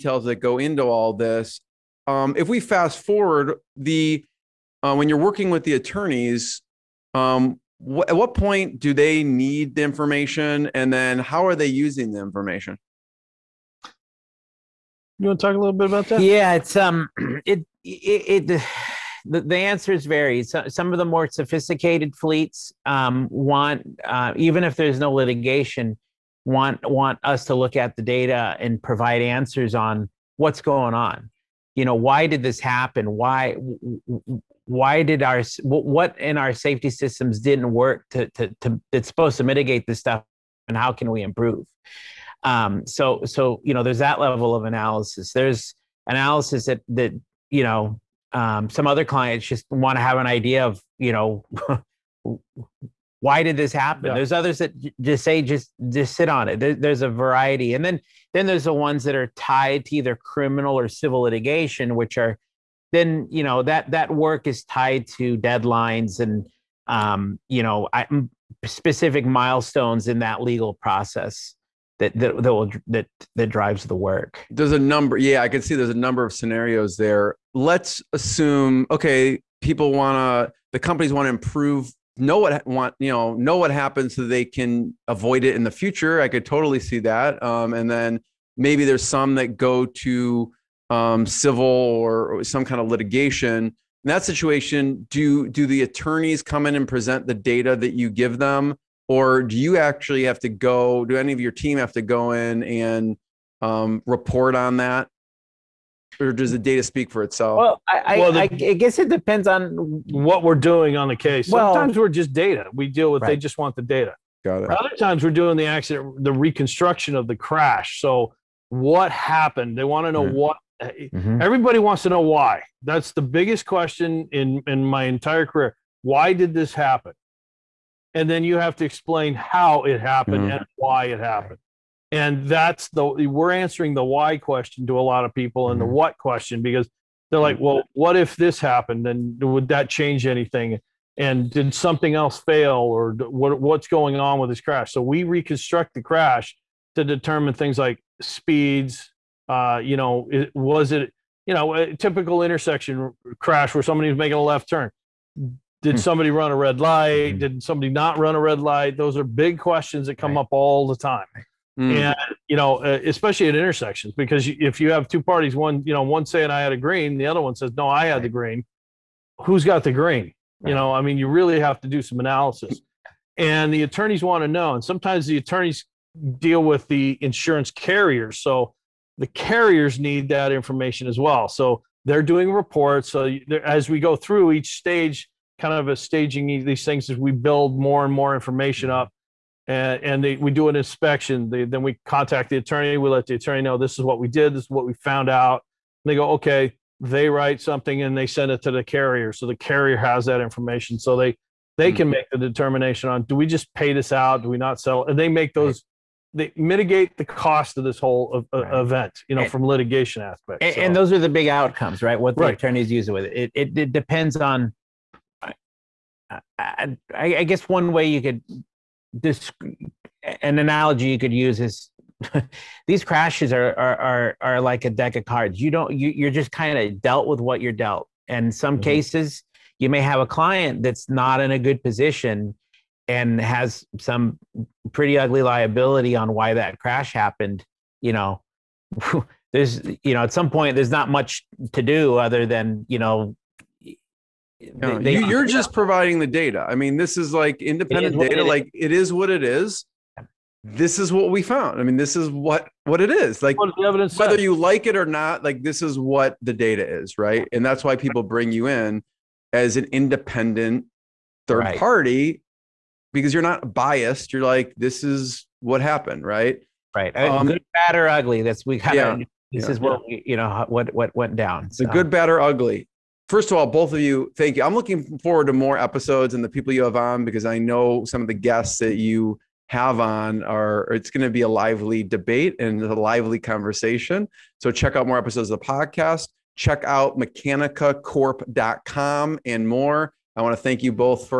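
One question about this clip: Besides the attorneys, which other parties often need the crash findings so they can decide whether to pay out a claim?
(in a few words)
Insurance carriers.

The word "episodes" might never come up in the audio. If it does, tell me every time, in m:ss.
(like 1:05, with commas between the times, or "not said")
4:35, 4:45.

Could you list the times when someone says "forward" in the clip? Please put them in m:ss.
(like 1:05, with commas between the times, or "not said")
0:03, 4:35.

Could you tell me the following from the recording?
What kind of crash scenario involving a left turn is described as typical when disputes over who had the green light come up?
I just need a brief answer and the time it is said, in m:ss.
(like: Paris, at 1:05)
Intersection crash, at 2:32.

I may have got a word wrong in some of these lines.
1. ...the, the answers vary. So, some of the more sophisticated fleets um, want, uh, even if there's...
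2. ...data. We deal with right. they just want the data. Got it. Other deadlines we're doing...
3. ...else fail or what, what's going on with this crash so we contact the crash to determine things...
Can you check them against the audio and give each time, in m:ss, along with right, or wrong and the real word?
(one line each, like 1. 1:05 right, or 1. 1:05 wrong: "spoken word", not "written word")
1. 0:19 right
2. 1:52 wrong: "times", not "deadlines"
3. 2:22 wrong: "reconstruct", not "contact".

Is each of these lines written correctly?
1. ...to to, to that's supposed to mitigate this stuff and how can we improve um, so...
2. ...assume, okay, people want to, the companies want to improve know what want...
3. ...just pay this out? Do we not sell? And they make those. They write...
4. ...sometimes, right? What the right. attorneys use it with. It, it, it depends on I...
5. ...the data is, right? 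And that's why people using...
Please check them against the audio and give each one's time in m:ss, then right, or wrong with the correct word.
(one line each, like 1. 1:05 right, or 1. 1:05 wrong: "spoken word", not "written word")
1. 0:38 right
2. 1:18 right
3. 3:23 wrong: "mitigate", not "write"
4. 3:31 wrong: "outcomes", not "sometimes"
5. 4:16 wrong: "bring", not "using".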